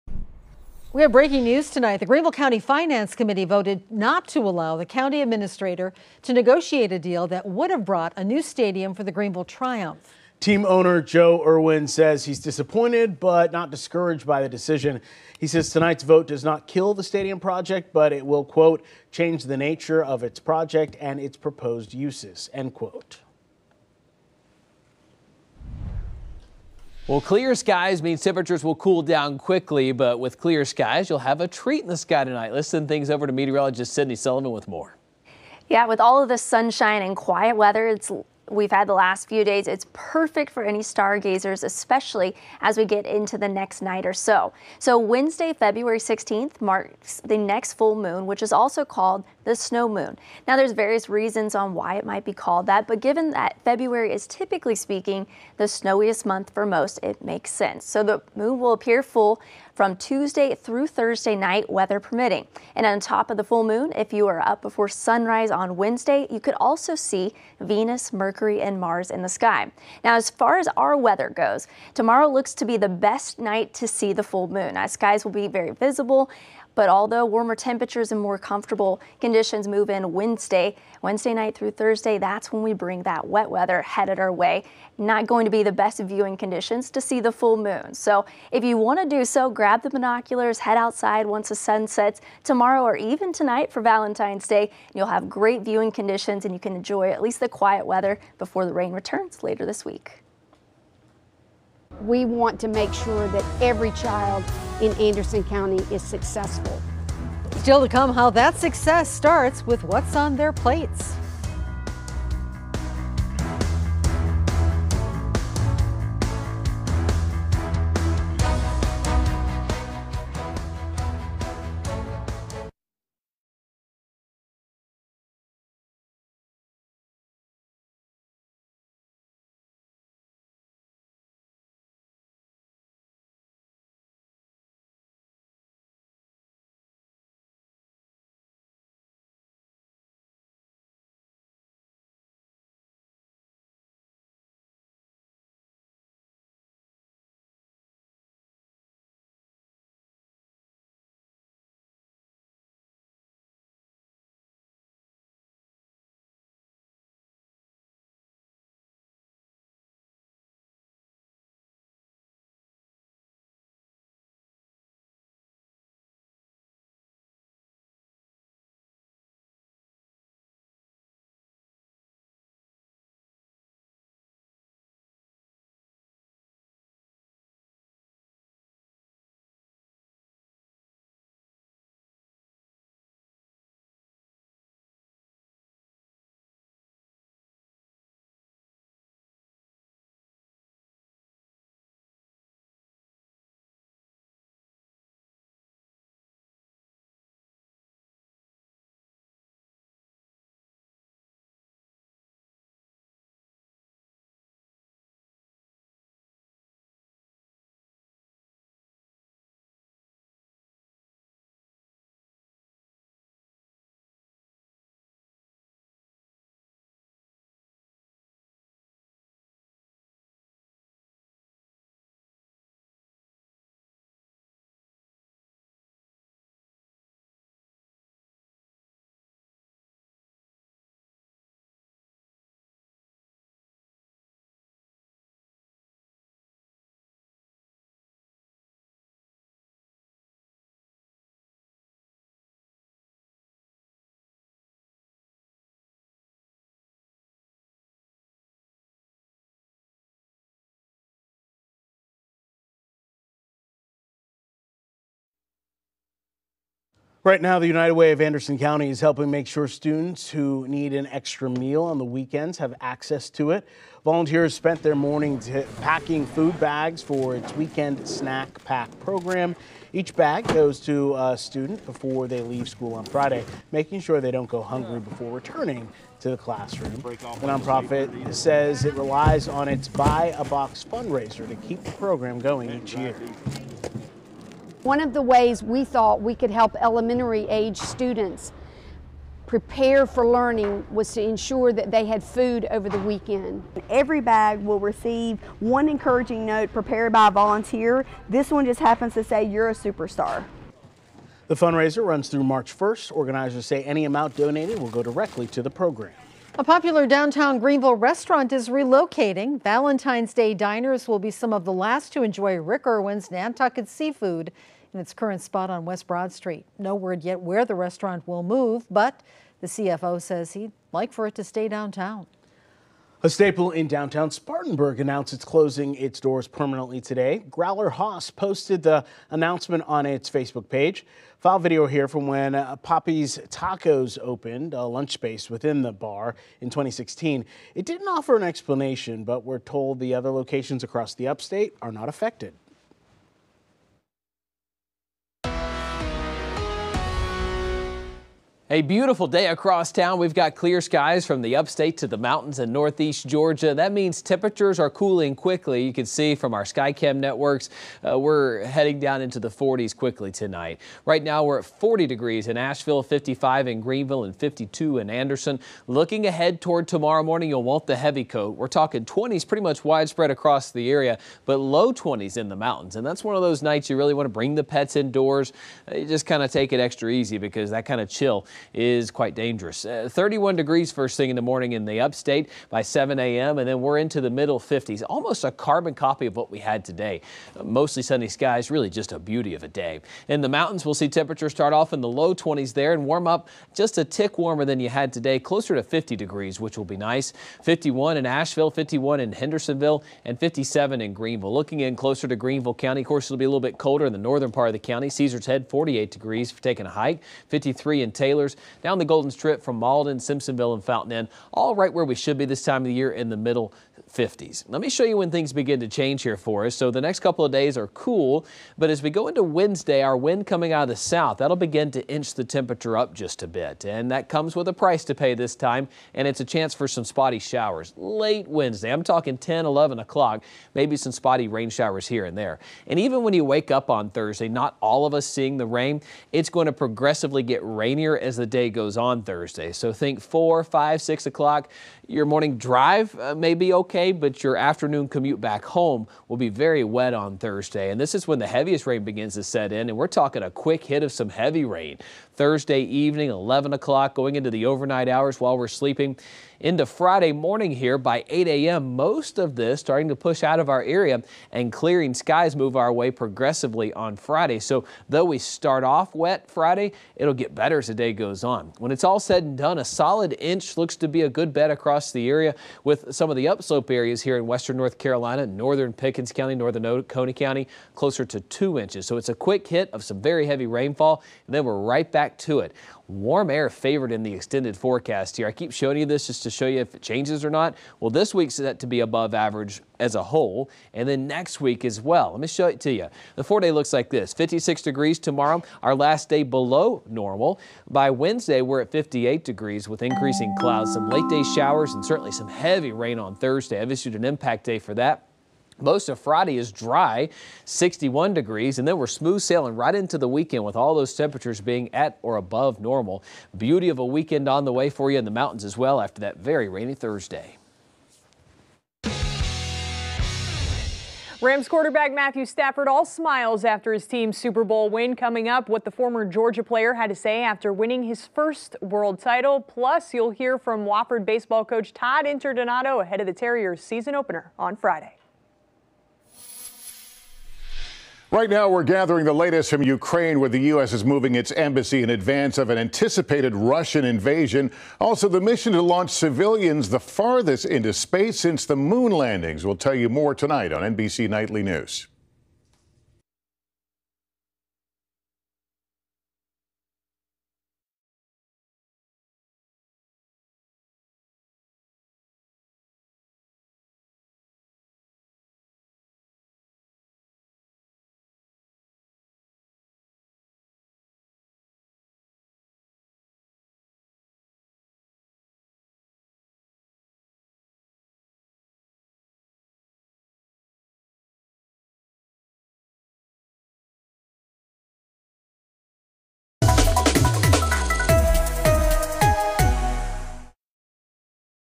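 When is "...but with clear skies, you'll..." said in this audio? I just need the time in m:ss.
0:29.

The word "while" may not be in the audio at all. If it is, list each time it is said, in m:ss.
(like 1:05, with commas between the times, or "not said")
7:35.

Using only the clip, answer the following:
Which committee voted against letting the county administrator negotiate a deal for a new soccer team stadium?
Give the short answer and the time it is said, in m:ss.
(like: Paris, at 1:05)
Greenville County Finance Committee, at 0:02.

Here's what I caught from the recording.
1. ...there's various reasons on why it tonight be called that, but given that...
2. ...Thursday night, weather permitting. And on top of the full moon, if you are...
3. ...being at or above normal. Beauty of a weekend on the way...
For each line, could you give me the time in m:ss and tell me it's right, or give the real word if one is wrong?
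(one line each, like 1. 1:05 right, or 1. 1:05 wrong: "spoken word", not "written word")
1. 0:50 wrong: "might", not "tonight"
2. 1:00 right
3. 8:31 right.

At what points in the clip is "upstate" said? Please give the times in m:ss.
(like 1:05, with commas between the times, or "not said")
5:41, 5:51, 6:22.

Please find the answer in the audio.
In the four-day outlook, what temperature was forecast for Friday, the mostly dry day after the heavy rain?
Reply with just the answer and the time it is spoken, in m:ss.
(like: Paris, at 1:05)
61 degrees, at 8:27.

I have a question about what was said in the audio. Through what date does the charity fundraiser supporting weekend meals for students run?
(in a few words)
March 1st.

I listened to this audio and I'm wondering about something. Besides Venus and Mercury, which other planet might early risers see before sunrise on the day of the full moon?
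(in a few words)
Mars.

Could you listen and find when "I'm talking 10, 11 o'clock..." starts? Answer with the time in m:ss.
7:08.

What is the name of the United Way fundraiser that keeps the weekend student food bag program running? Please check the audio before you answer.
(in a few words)
Buy a Box.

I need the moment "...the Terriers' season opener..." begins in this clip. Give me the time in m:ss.
8:53.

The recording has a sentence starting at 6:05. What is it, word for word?
Looking ahead toward tomorrow morning, you'll want the heavy coat.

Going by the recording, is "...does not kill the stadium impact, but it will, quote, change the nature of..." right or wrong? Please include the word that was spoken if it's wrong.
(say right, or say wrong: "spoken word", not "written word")
wrong: "project", not "impact".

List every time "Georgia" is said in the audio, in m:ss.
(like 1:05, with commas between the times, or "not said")
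5:53, 8:46.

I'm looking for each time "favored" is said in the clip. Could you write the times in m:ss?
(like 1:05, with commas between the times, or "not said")
8:03.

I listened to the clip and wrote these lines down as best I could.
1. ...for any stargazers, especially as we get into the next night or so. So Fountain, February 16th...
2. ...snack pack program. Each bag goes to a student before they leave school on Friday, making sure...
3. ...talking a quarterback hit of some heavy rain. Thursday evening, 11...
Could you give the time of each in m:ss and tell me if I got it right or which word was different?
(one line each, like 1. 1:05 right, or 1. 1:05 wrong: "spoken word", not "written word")
1. 0:40 wrong: "Wednesday", not "Fountain"
2. 4:28 right
3. 7:30 wrong: "quick", not "quarterback".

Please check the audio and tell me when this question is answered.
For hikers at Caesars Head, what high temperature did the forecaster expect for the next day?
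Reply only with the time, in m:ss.
6:45.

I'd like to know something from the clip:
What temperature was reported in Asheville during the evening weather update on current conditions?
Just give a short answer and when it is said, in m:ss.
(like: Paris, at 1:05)
40 degrees, at 6:01.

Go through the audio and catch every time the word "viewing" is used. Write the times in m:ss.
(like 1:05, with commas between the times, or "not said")
1:25, 1:35.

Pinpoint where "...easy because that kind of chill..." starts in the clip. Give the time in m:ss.
6:17.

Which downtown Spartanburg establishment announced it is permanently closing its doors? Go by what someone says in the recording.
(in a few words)
Growler Haus.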